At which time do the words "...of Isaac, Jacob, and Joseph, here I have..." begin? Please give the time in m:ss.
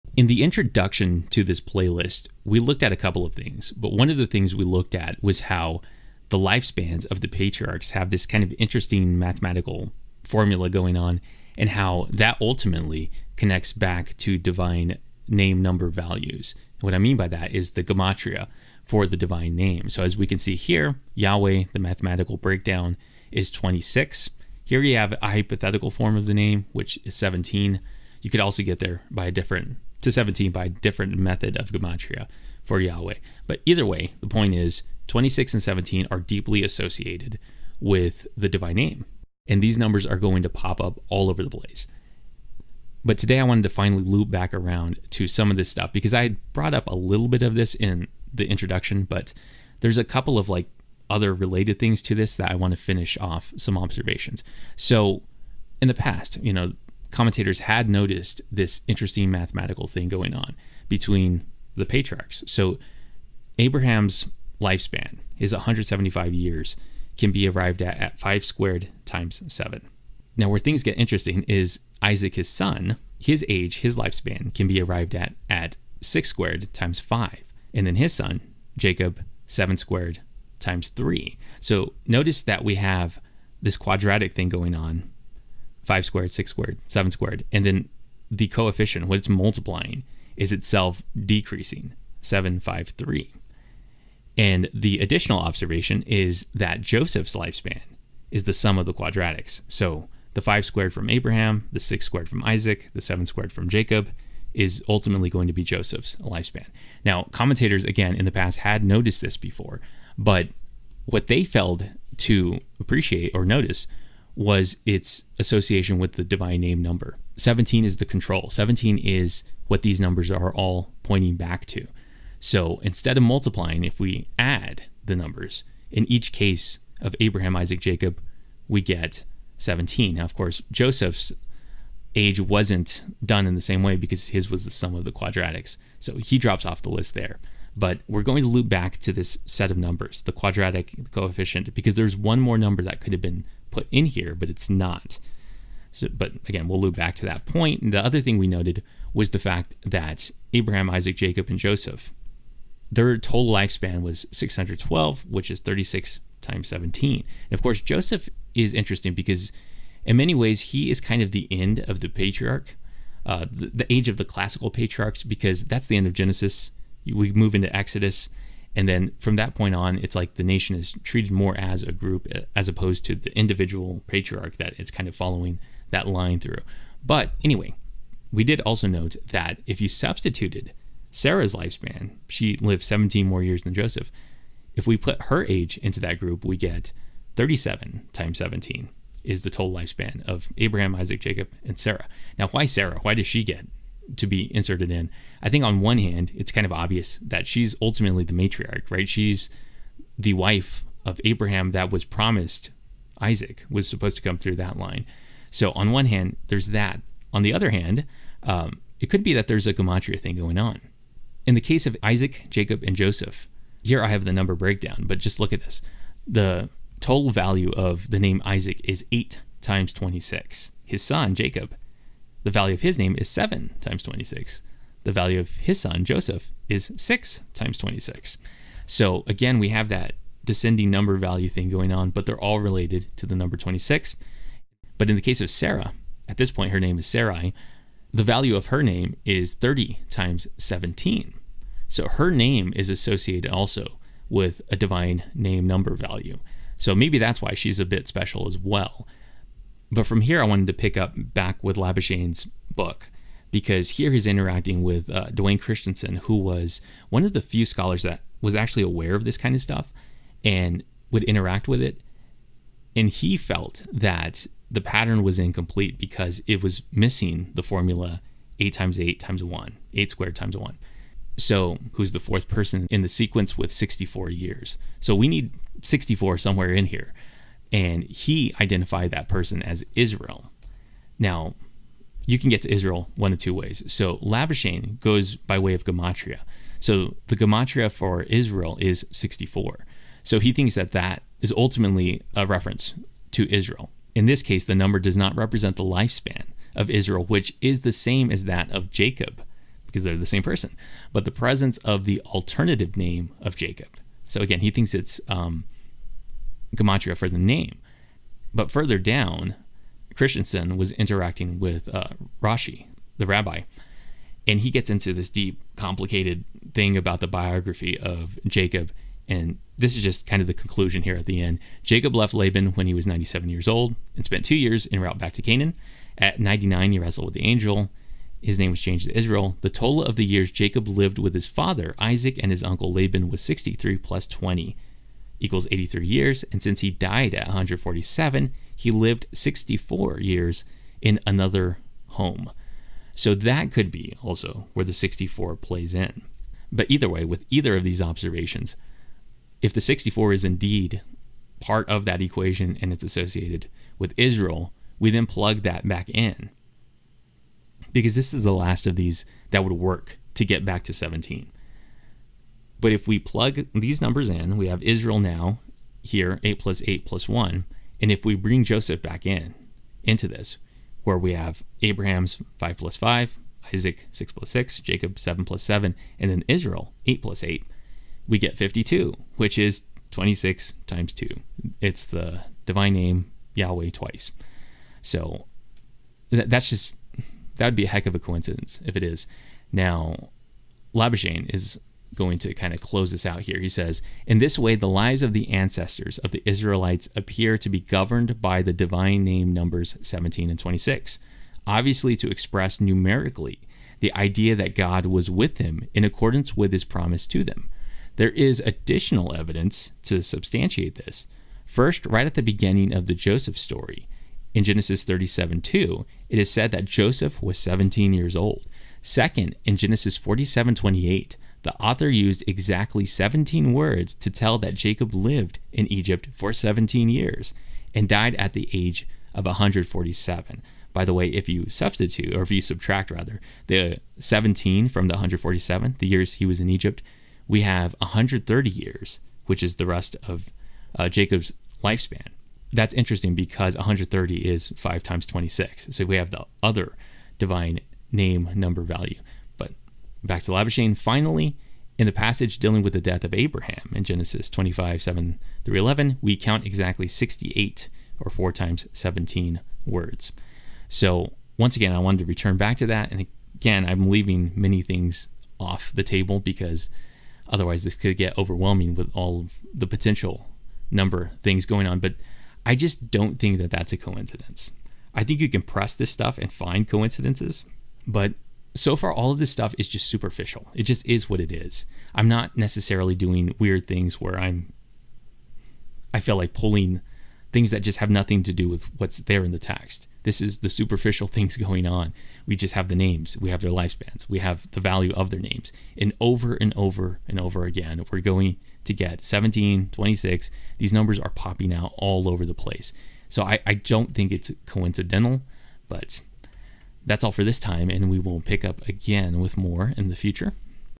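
3:31.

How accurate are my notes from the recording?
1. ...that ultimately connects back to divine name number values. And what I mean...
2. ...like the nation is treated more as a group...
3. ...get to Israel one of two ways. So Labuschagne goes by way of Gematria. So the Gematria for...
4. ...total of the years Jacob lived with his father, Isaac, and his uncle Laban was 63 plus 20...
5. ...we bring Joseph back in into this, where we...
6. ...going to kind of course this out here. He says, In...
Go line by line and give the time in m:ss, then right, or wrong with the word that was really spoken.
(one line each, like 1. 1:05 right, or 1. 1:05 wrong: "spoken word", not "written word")
1. 0:12 right
2. 2:50 right
3. 4:42 right
4. 5:29 right
5. 6:08 right
6. 6:32 wrong: "close", not "course".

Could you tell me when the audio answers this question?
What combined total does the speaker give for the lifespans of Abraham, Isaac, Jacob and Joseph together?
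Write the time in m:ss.
2:34.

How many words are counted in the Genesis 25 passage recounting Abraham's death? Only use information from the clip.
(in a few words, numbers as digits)
68.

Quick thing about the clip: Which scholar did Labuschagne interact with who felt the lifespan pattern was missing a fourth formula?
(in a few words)
Duane Christensen.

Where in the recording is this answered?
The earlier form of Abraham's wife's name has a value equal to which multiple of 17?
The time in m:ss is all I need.
3:59.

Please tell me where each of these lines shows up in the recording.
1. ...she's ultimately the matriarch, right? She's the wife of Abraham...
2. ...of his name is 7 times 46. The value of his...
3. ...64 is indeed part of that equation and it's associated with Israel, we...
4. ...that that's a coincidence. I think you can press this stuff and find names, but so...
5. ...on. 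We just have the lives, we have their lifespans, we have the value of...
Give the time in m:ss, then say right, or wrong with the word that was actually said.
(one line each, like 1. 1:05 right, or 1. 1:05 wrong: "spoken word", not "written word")
1. 3:17 right
2. 3:42 wrong: "26", not "46"
3. 5:49 right
4. 7:53 wrong: "coincidences", not "names"
5. 8:11 wrong: "names", not "lives".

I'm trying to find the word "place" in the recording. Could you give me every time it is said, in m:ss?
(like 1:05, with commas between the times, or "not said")
0:41, 8:22.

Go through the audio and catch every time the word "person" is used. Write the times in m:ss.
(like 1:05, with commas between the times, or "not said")
4:32, 4:39, 5:00.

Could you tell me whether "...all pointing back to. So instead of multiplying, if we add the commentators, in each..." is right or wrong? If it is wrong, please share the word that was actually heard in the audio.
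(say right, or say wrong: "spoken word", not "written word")
wrong: "numbers", not "commentators".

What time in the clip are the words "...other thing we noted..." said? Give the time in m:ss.
2:28.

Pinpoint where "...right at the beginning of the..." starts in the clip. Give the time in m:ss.
6:52.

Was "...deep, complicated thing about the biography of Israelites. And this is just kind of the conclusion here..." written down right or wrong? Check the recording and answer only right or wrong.
wrong.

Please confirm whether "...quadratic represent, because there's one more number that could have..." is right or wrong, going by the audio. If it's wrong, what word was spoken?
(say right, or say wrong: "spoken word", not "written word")
wrong: "coefficient", not "represent".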